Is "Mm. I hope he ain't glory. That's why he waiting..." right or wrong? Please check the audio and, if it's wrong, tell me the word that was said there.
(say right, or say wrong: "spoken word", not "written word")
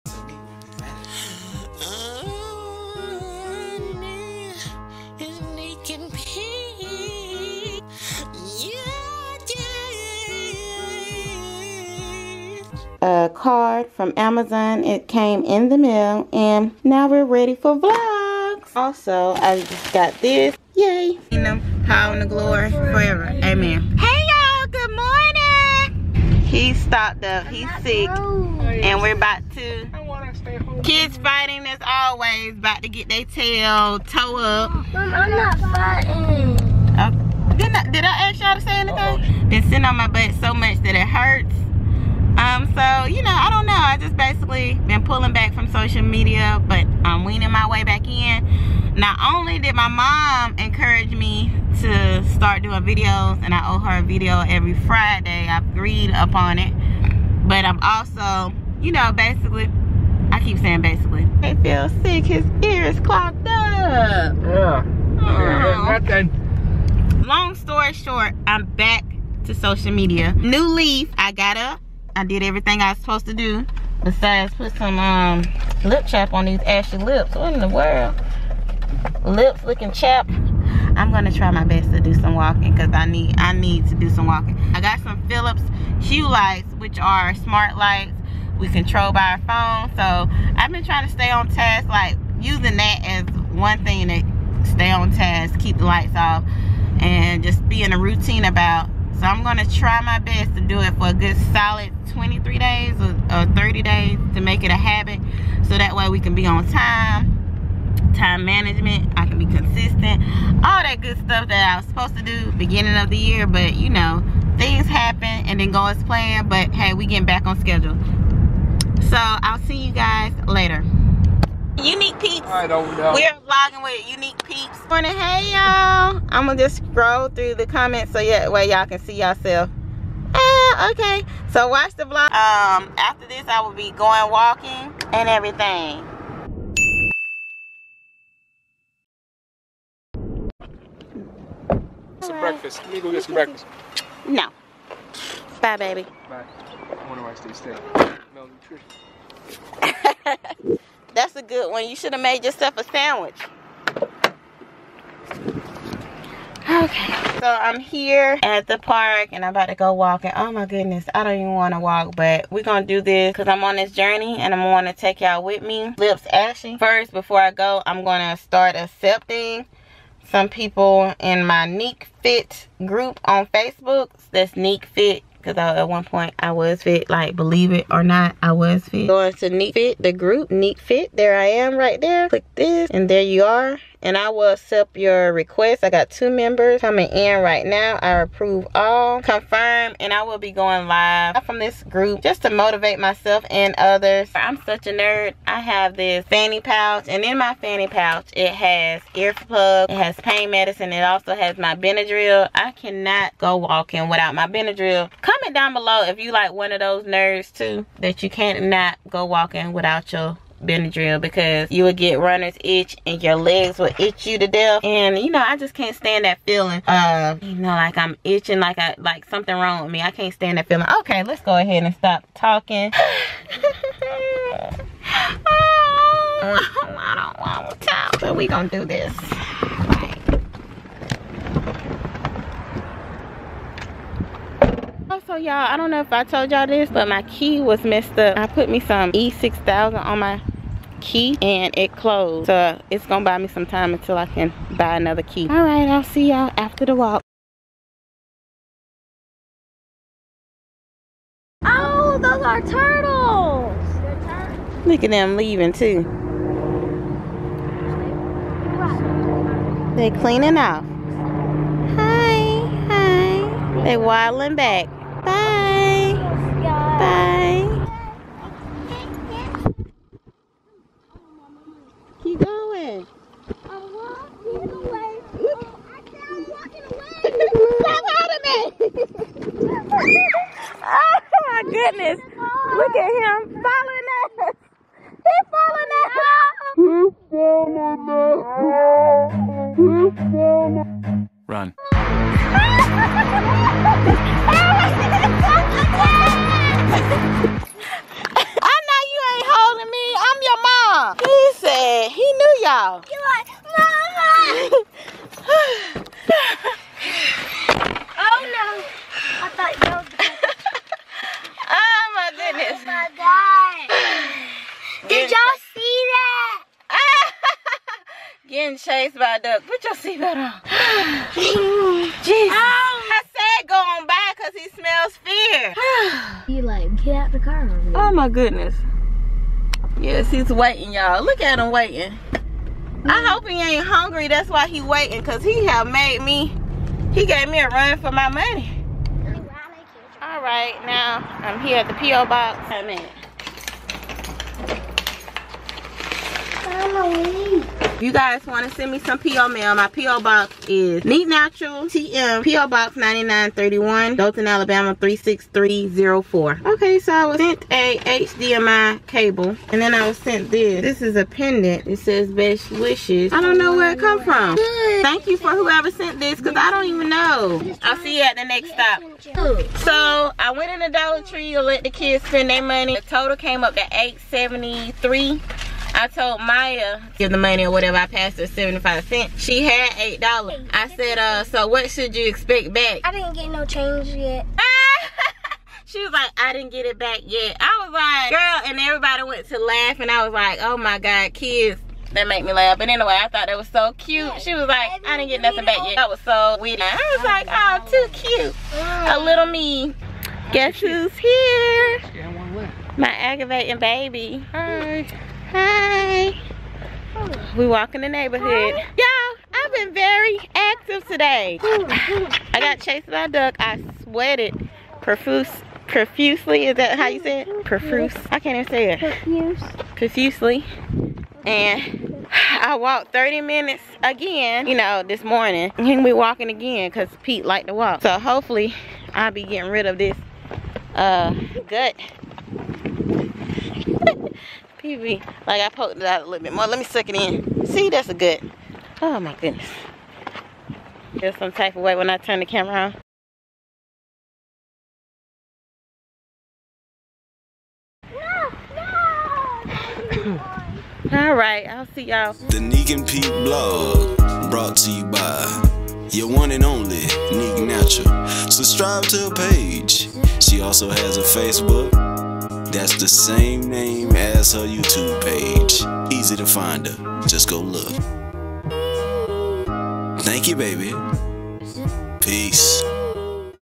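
wrong: "hungry", not "glory".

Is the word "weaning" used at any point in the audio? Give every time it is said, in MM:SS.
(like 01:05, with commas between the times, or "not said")
00:47.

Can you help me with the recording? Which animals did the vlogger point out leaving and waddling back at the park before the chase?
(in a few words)
turtles.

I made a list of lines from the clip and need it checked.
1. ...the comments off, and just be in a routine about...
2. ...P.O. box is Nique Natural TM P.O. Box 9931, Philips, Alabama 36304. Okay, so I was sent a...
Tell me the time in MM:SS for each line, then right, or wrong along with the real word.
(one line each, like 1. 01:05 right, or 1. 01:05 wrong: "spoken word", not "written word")
1. 01:35 wrong: "lights", not "comments"
2. 05:49 wrong: "Dothan", not "Philips".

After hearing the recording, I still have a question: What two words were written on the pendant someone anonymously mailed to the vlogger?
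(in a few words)
best wishes.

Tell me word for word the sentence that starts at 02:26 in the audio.
I wonder why I stay still.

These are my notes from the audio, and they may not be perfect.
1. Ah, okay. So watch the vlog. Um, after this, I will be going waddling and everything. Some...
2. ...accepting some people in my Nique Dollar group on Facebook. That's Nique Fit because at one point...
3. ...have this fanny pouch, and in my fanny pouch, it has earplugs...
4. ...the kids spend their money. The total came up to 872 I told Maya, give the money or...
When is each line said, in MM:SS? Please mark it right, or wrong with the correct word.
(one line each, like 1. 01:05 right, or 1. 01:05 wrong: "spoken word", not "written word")
1. 02:10 wrong: "walking", not "waddling"
2. 02:48 wrong: "Fit", not "Dollar"
3. 03:15 right
4. 06:11 wrong: "873", not "872".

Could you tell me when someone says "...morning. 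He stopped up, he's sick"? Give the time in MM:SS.
00:24.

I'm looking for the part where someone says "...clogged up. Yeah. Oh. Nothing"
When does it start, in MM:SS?
01:03.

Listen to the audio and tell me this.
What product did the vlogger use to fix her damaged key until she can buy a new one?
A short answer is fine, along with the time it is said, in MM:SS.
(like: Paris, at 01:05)
E6000, at 03:59.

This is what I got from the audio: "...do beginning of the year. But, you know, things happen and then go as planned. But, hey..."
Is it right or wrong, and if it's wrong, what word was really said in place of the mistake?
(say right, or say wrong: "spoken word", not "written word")
right.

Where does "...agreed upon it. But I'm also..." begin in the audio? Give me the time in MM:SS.
00:55.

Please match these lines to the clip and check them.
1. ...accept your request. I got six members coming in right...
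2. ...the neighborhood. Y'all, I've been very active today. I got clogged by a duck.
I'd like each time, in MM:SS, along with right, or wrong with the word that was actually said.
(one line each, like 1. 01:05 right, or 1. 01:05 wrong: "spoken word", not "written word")
1. 03:04 wrong: "two", not "six"
2. 06:48 wrong: "chased", not "clogged".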